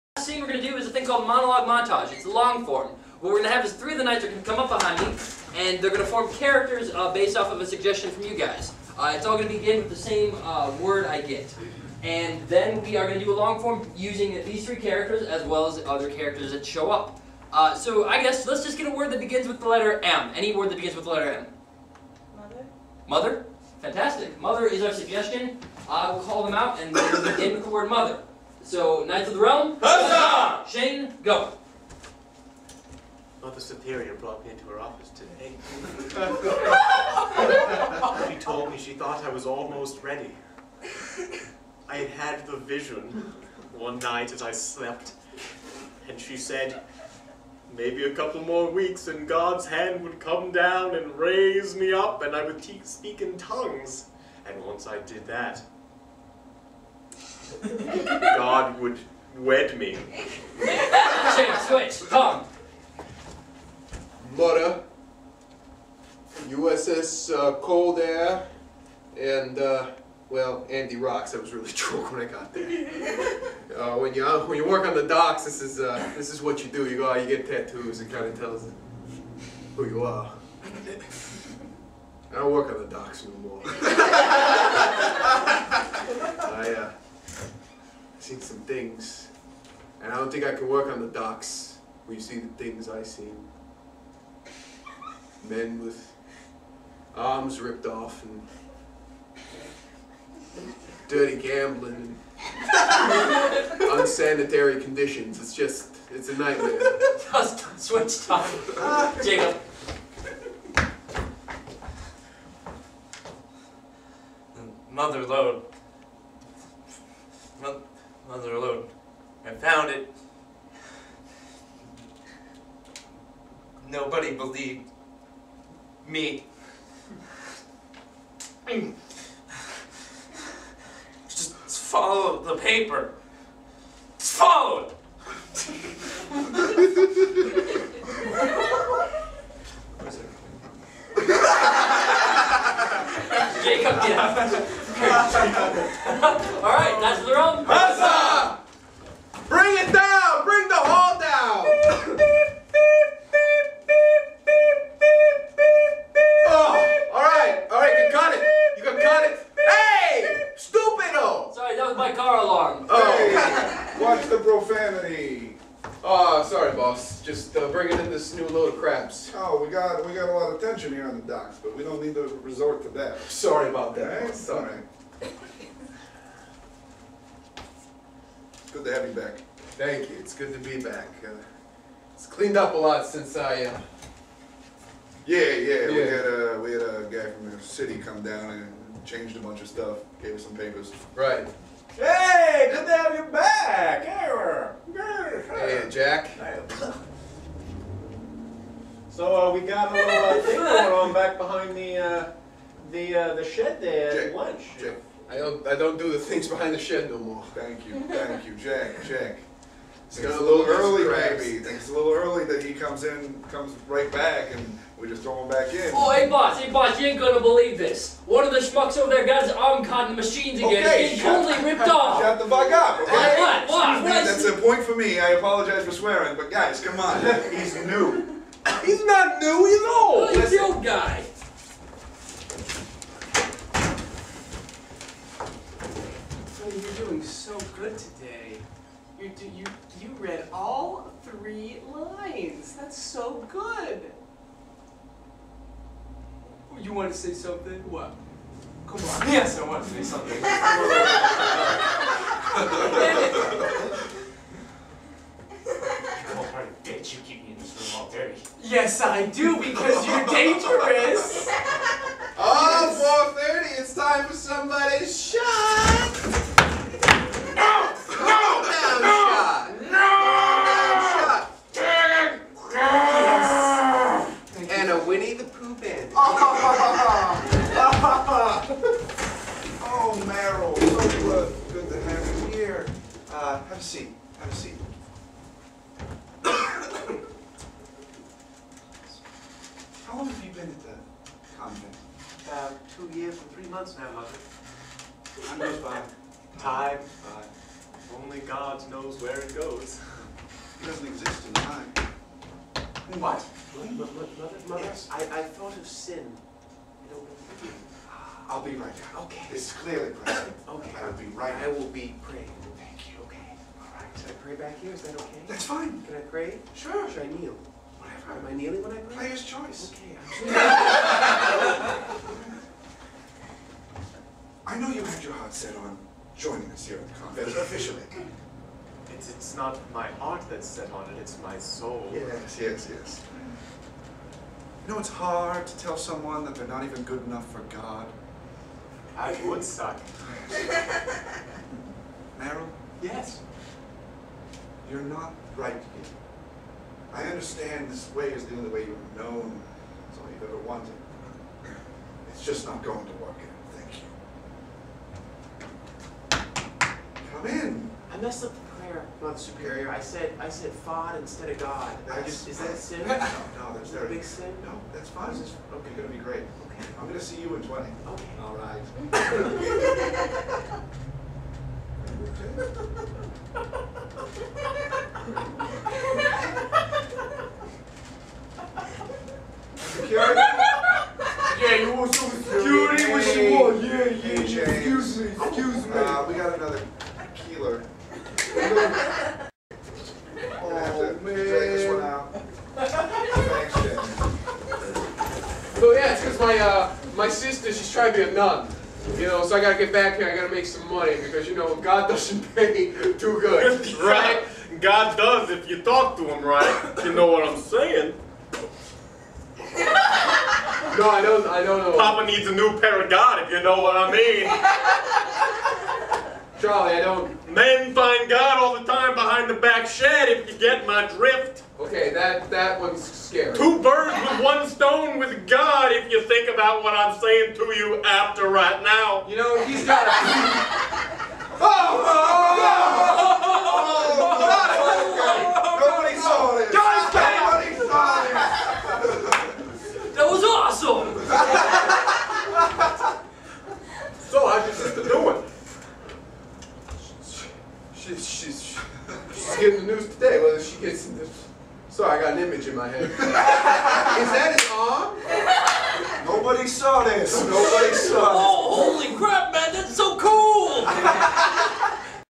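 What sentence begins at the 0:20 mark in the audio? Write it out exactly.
Any word that begins with the letter M.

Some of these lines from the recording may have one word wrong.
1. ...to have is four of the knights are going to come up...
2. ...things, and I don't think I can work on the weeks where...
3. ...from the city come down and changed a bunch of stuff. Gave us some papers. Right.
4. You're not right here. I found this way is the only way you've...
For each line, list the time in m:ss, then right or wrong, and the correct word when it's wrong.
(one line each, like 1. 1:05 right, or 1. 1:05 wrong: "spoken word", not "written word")
1. 0:03 wrong: "three", not "four"
2. 1:28 wrong: "docks", not "weeks"
3. 3:07 right
4. 5:44 wrong: "understand", not "found".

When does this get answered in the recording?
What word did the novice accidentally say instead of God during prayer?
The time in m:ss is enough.
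6:00.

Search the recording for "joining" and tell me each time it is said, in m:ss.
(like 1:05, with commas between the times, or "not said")
5:26.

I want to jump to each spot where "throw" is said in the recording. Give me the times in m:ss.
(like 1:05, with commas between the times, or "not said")
3:35.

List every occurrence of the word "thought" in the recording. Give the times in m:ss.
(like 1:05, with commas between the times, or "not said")
0:38, 5:05.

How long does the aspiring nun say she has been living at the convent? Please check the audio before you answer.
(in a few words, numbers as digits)
About two years and three months.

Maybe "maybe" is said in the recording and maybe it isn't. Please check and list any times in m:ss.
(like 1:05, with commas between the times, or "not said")
0:47, 3:31.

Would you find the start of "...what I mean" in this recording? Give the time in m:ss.
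6:53.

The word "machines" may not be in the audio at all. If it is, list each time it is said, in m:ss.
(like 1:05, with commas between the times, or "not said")
3:40.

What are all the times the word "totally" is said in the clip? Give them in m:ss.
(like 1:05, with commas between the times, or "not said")
3:41.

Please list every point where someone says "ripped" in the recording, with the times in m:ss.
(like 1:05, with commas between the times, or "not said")
1:37, 3:41.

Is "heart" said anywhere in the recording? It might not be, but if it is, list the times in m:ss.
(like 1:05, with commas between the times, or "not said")
5:25.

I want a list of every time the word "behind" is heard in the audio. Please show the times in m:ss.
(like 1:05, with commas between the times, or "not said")
0:04, 3:21, 3:26, 6:59.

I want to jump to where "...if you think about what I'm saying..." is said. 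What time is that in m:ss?
7:05.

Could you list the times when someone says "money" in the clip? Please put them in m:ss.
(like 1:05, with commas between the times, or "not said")
6:40.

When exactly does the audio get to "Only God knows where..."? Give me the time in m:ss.
4:58.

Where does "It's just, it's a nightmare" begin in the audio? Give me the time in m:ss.
1:45.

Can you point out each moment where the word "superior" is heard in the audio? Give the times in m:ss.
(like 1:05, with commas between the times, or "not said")
0:33, 5:59.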